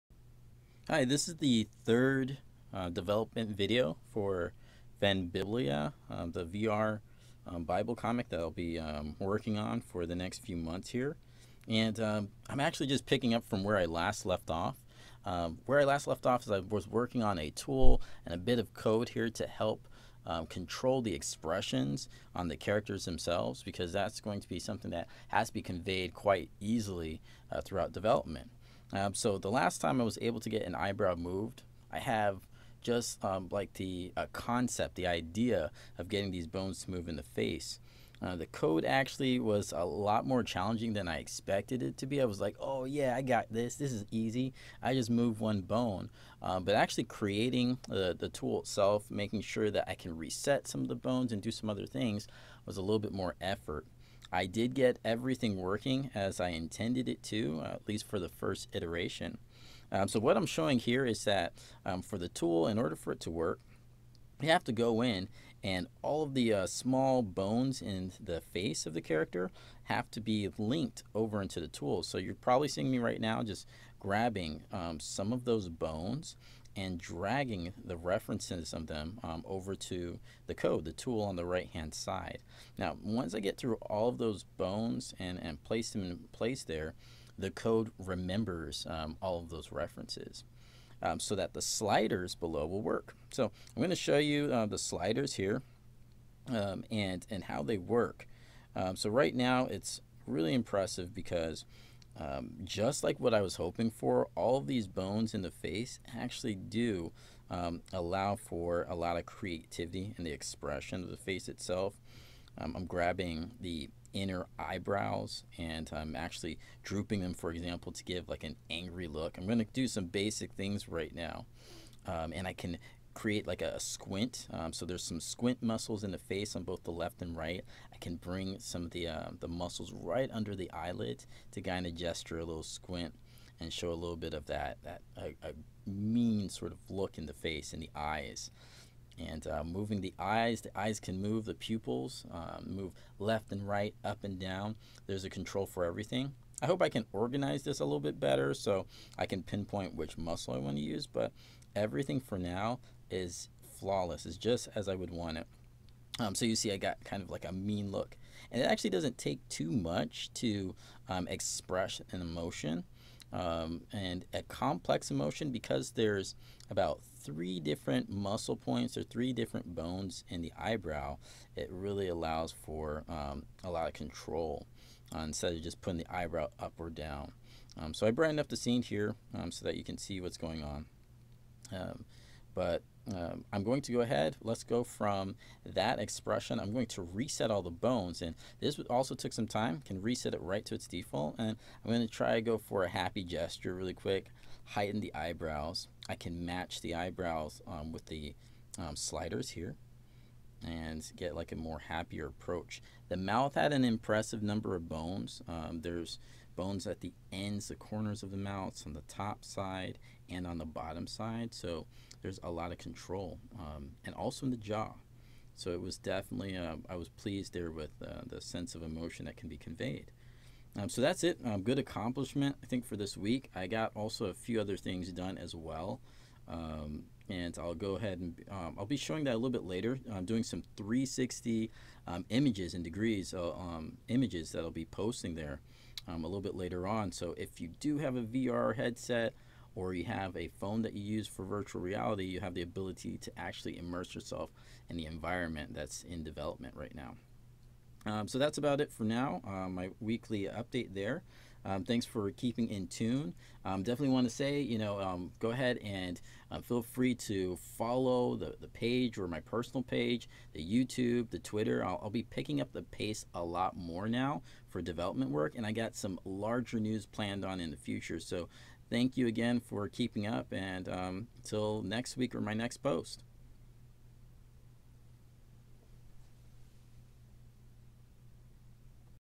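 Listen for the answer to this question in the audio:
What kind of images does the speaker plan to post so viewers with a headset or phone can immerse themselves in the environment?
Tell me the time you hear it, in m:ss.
3:50.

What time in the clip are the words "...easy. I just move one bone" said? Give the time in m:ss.
0:44.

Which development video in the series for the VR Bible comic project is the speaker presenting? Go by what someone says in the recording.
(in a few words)
Third.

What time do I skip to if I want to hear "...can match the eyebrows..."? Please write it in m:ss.
3:16.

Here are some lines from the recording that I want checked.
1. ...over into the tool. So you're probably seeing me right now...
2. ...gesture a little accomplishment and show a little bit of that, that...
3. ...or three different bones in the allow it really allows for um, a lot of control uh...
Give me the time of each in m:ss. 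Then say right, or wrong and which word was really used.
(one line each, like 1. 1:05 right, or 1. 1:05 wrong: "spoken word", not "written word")
1. 1:11 right
2. 2:11 wrong: "squint", not "accomplishment"
3. 2:48 wrong: "eyebrow", not "allow".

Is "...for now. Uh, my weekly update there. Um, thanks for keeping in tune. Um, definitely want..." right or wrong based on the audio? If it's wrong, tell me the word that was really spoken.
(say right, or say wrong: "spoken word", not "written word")
right.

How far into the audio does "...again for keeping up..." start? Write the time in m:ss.
4:29.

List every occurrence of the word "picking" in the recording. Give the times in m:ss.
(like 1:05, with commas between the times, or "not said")
0:13, 4:22.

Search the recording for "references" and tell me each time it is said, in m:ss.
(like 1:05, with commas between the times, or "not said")
1:17, 1:29.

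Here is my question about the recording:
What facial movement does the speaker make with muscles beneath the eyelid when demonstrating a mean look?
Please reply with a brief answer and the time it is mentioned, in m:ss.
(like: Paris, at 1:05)
A squint, at 2:03.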